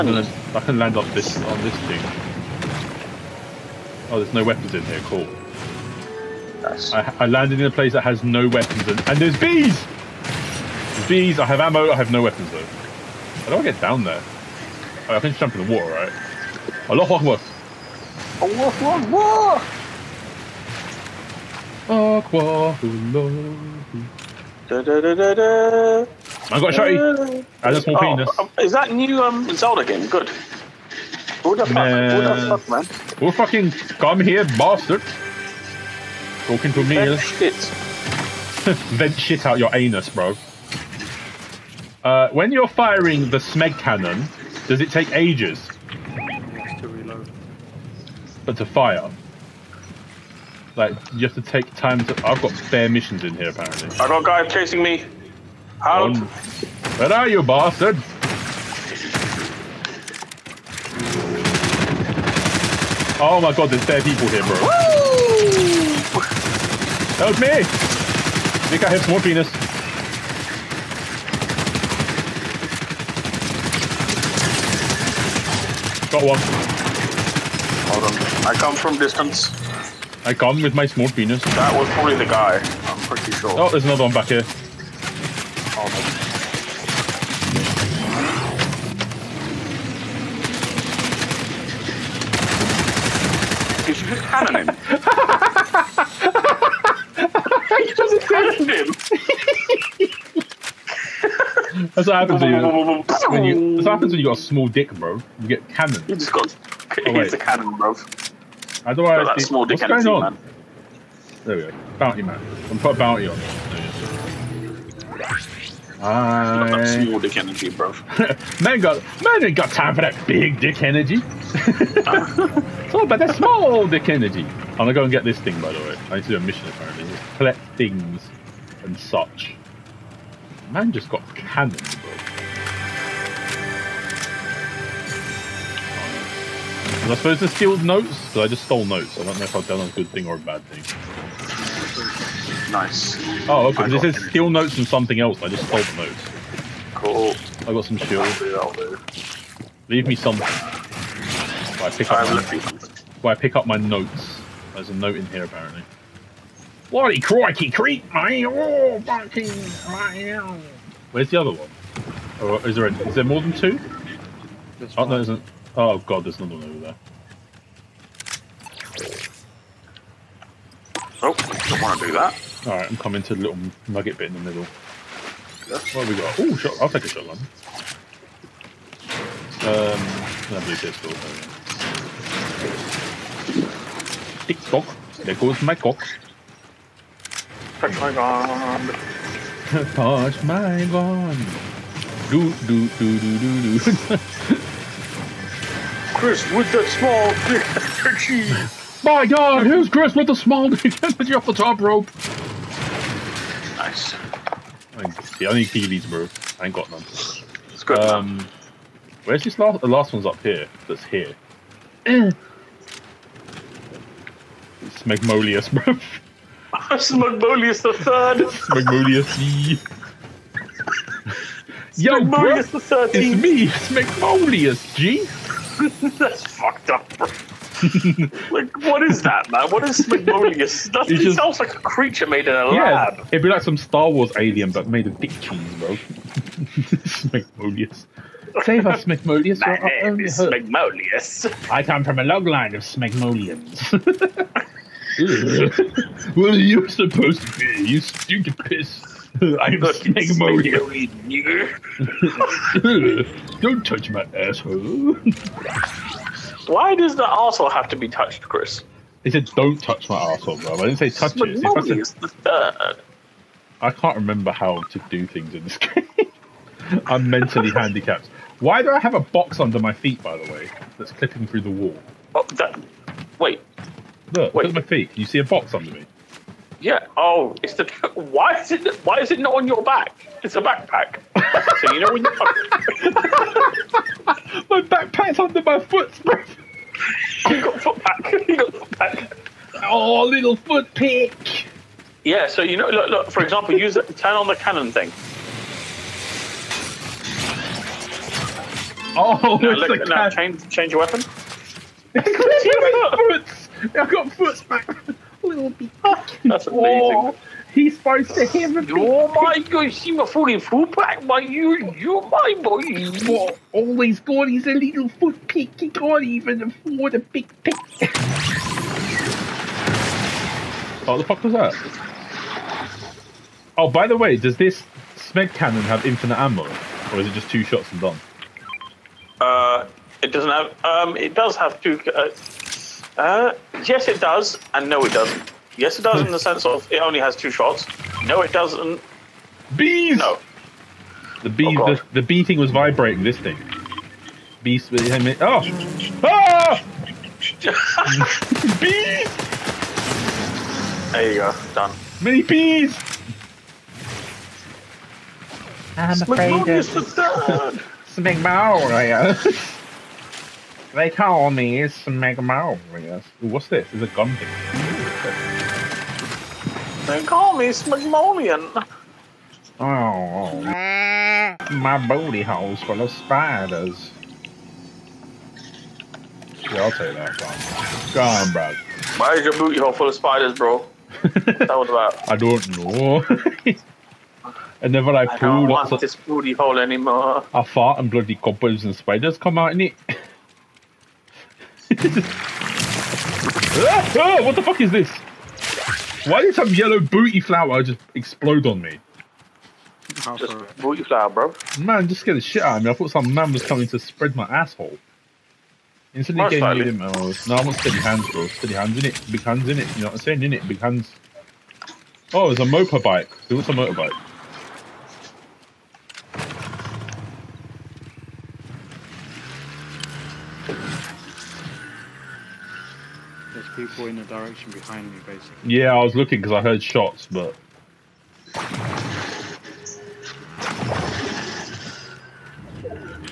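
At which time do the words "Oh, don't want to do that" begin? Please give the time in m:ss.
2:51.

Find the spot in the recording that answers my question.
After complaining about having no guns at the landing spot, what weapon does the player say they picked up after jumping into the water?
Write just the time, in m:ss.
0:22.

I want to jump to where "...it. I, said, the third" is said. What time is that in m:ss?
4:21.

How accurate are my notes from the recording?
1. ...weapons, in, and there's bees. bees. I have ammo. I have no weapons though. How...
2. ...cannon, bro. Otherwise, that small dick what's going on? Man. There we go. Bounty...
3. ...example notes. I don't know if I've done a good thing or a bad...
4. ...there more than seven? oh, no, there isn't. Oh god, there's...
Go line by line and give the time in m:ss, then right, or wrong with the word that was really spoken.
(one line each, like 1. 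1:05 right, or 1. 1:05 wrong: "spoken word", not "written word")
1. 0:08 right
2. 1:47 right
3. 2:18 wrong: "stole", not "example"
4. 2:43 wrong: "two", not "seven".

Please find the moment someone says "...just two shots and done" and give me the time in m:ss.
5:27.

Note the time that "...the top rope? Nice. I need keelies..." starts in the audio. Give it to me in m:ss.
3:21.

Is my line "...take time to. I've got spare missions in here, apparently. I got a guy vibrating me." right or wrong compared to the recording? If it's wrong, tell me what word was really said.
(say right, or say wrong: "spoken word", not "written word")
wrong: "chasing", not "vibrating".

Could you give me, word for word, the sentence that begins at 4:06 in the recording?
what are you supposed to be, you stupid piss?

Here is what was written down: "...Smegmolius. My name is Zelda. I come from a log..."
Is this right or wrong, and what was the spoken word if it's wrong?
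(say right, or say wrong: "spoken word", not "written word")
wrong: "Smegmolius", not "Zelda".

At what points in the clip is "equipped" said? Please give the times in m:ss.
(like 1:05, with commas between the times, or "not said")
not said.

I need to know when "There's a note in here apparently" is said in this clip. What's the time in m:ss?
2:34.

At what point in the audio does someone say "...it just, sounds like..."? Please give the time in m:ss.
3:51.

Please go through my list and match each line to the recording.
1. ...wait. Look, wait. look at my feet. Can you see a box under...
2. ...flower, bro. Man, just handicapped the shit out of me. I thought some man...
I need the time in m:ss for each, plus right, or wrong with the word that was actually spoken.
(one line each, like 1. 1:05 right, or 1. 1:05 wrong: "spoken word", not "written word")
1. 4:33 right
2. 6:41 wrong: "scared", not "handicapped".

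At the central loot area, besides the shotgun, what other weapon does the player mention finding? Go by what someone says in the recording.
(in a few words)
Pistol.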